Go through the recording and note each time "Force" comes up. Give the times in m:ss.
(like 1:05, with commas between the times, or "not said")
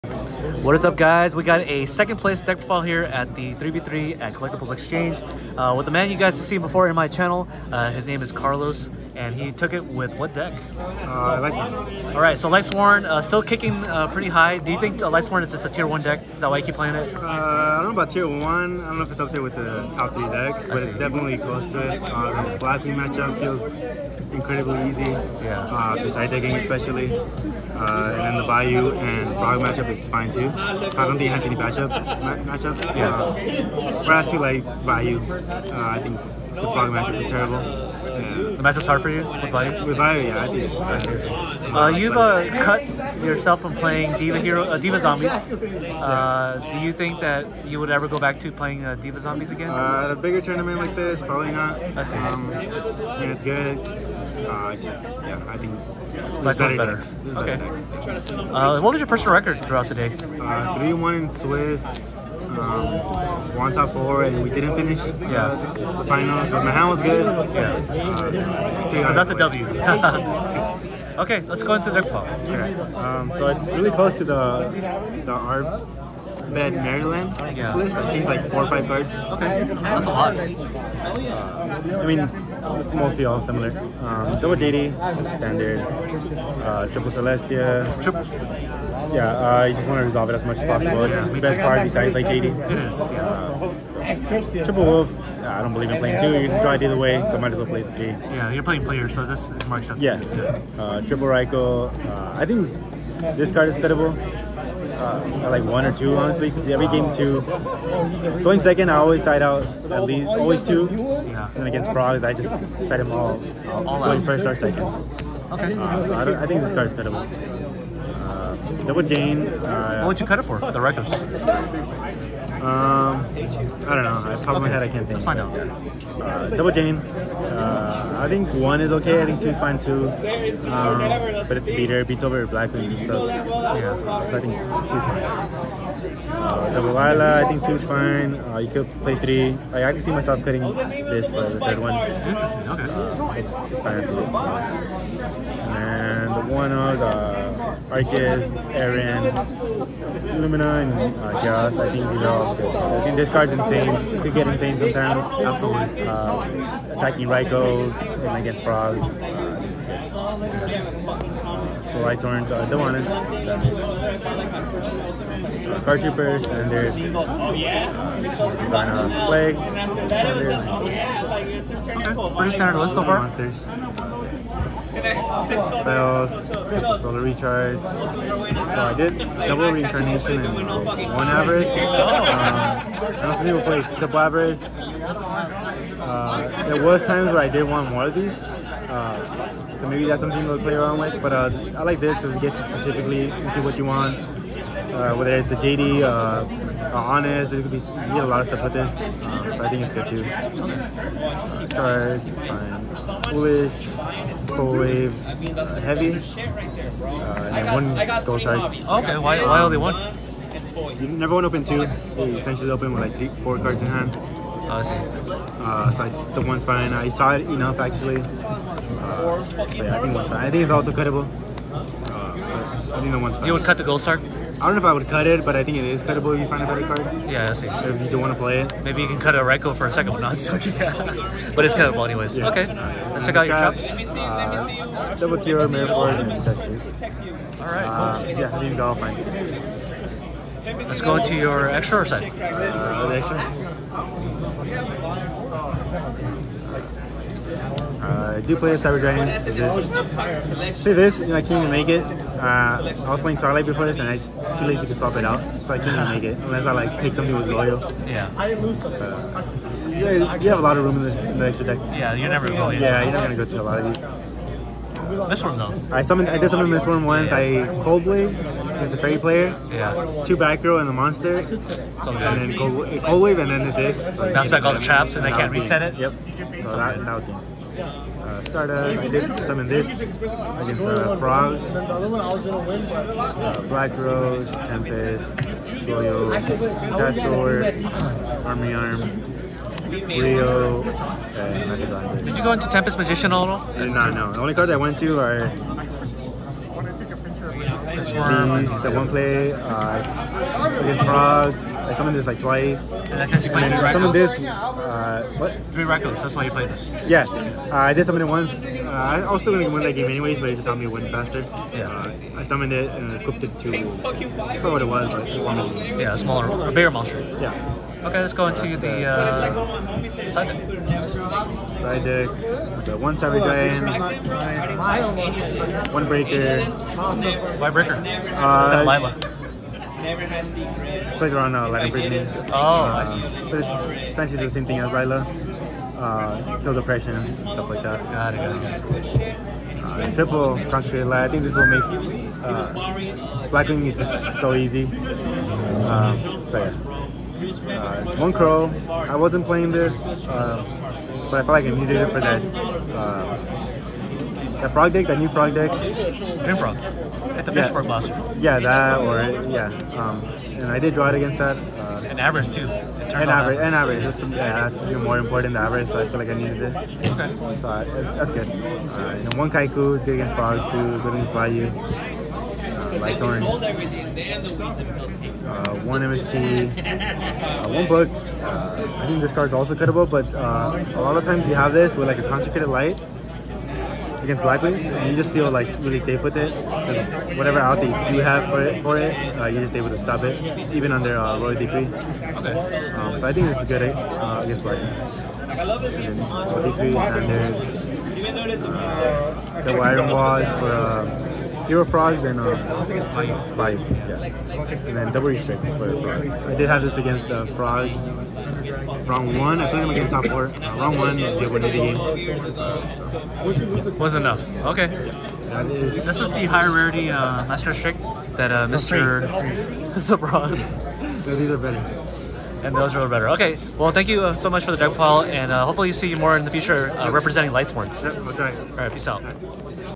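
3:55.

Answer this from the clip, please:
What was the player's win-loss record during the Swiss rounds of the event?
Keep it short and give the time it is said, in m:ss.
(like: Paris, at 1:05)
3-1, at 1:00.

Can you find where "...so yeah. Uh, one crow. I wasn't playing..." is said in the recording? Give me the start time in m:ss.
5:46.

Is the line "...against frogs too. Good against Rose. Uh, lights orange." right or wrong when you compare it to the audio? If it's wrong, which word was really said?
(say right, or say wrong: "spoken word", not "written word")
wrong: "Bayou", not "Rose".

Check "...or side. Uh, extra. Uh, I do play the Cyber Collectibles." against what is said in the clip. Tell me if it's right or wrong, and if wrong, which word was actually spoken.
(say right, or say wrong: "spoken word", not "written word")
wrong: "Dragon", not "Collectibles".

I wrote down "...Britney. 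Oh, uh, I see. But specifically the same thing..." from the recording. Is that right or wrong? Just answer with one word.
wrong.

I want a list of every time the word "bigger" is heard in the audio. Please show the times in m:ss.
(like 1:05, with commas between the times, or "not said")
0:50, 5:16.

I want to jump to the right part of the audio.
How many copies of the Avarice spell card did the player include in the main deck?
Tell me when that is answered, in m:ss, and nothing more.
3:00.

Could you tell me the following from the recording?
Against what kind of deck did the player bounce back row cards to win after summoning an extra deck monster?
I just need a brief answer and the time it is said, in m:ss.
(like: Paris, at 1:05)
Fairy, at 4:28.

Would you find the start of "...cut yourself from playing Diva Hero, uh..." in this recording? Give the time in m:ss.
0:42.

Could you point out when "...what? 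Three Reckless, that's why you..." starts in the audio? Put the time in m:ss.
5:05.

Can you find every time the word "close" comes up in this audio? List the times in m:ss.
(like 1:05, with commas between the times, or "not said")
0:21, 1:13.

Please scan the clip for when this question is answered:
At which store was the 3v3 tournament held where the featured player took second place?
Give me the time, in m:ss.
0:04.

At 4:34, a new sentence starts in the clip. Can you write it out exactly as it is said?
So Bounce back all the traps and they can't reset it?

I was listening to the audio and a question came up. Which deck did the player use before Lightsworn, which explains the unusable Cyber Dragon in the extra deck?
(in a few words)
Twilight.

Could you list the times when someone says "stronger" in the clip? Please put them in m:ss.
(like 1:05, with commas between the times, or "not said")
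not said.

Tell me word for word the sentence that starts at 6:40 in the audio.
Uh, Hero frogs and uh, bite.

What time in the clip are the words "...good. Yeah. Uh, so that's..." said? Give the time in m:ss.
1:07.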